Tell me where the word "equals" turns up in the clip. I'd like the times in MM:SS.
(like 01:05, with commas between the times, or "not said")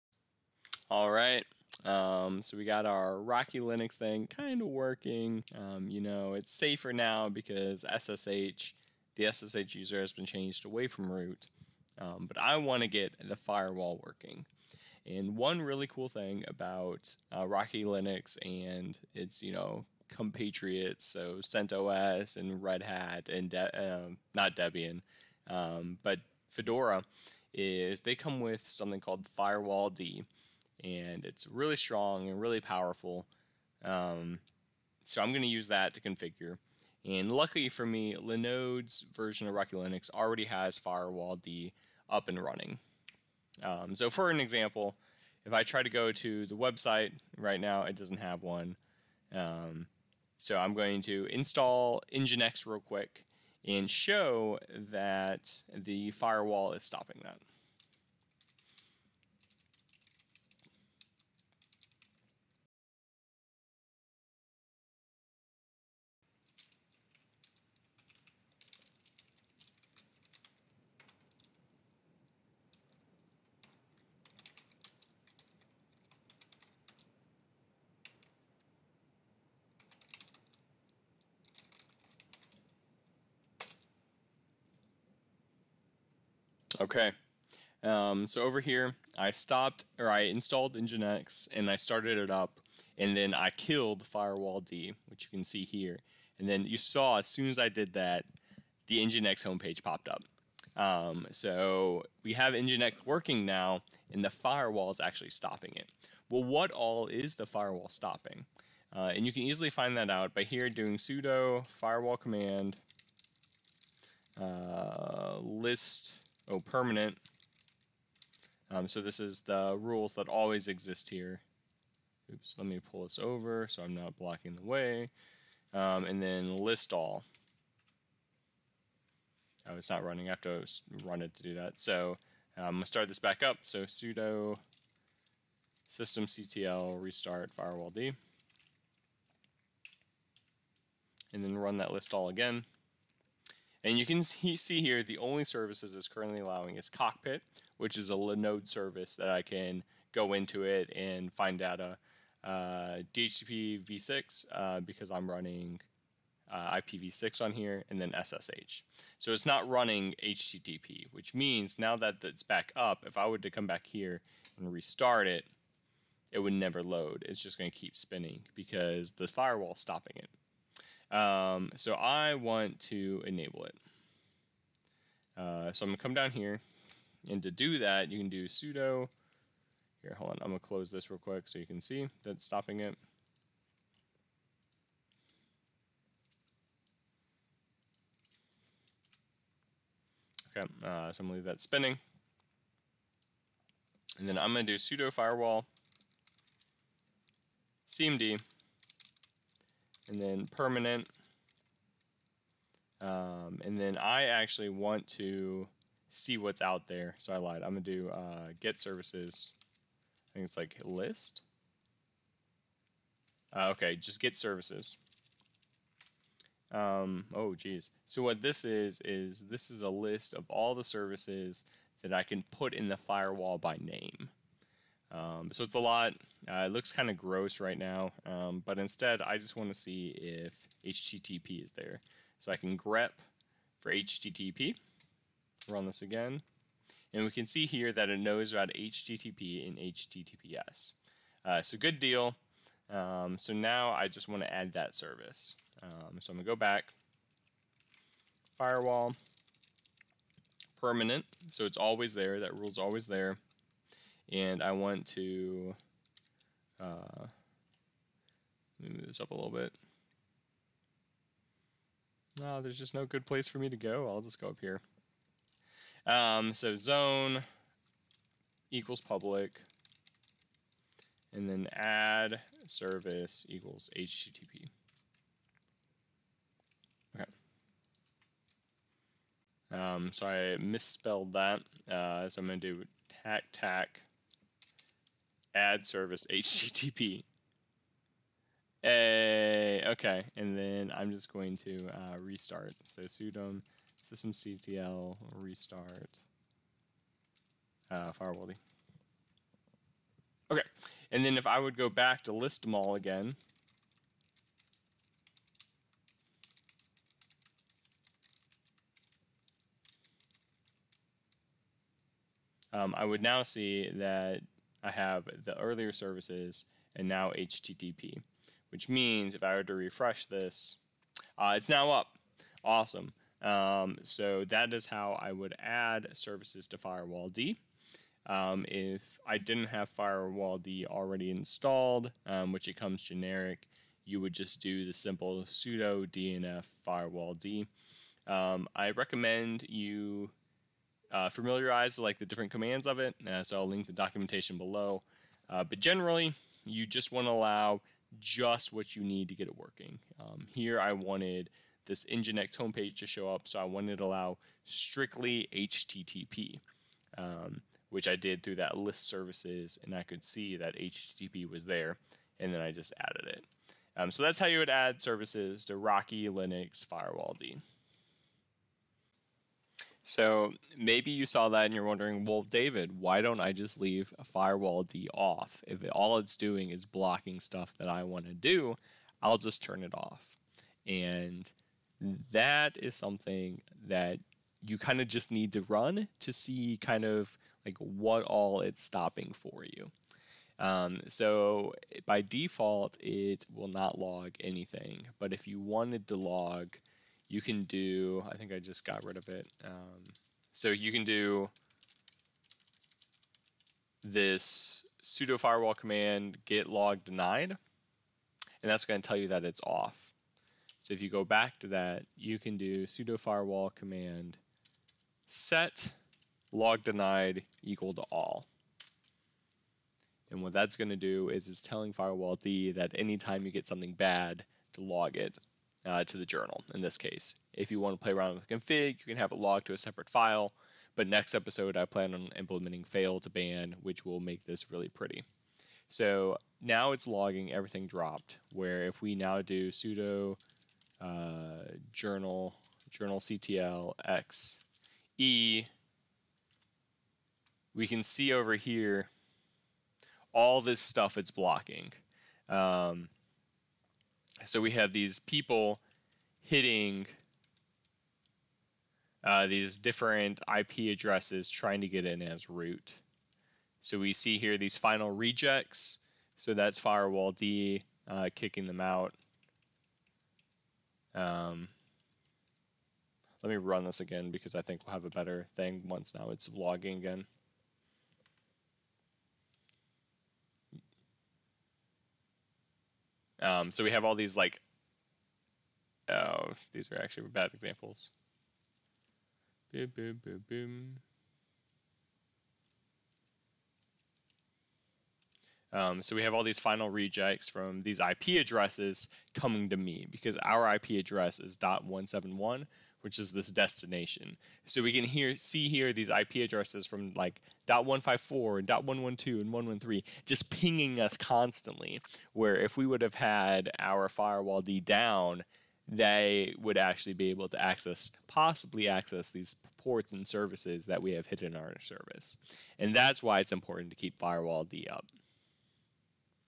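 04:28, 04:33, 06:57.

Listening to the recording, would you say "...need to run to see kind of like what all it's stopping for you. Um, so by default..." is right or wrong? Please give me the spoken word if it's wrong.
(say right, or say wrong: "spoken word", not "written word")
right.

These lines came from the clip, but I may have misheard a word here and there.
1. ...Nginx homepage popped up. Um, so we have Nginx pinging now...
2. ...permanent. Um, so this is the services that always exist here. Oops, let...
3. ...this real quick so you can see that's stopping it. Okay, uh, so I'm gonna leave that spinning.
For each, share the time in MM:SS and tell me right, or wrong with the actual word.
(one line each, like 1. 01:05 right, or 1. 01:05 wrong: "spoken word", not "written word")
1. 01:39 wrong: "working", not "pinging"
2. 01:56 wrong: "rules", not "services"
3. 03:00 right.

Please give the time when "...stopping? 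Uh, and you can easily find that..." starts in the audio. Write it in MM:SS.
01:47.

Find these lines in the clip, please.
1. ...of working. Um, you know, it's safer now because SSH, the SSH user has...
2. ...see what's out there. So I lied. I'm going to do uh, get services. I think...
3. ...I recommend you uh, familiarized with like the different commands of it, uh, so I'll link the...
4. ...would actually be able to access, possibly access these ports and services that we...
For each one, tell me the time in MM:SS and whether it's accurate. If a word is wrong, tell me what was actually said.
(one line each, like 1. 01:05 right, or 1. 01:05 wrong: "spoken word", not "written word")
1. 00:04 right
2. 03:26 right
3. 05:38 right
4. 08:36 right.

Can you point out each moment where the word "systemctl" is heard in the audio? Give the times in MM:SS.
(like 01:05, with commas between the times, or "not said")
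02:15, 04:54.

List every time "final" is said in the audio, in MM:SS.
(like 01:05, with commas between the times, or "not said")
07:44, 08:16.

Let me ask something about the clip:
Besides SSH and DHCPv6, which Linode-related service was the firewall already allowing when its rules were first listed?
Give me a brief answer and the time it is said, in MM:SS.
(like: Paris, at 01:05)
Cockpit, at 02:26.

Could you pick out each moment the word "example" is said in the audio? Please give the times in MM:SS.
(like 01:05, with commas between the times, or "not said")
00:44, 08:07.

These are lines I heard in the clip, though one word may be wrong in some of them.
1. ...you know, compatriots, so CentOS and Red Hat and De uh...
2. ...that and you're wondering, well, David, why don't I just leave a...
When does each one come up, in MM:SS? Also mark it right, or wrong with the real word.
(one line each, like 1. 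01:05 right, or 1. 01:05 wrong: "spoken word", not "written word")
1. 00:19 right
2. 06:11 right.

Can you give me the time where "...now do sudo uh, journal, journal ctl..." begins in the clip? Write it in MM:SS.
07:19.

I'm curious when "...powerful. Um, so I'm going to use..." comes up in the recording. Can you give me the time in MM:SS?
00:32.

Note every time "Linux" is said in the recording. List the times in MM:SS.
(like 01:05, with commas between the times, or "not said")
00:03, 00:17, 00:39, 06:06.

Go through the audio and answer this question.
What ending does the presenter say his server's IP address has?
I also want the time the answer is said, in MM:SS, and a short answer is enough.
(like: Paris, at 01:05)
.171, at 08:21.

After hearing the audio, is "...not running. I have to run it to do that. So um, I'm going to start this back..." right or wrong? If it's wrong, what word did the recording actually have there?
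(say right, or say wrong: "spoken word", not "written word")
right.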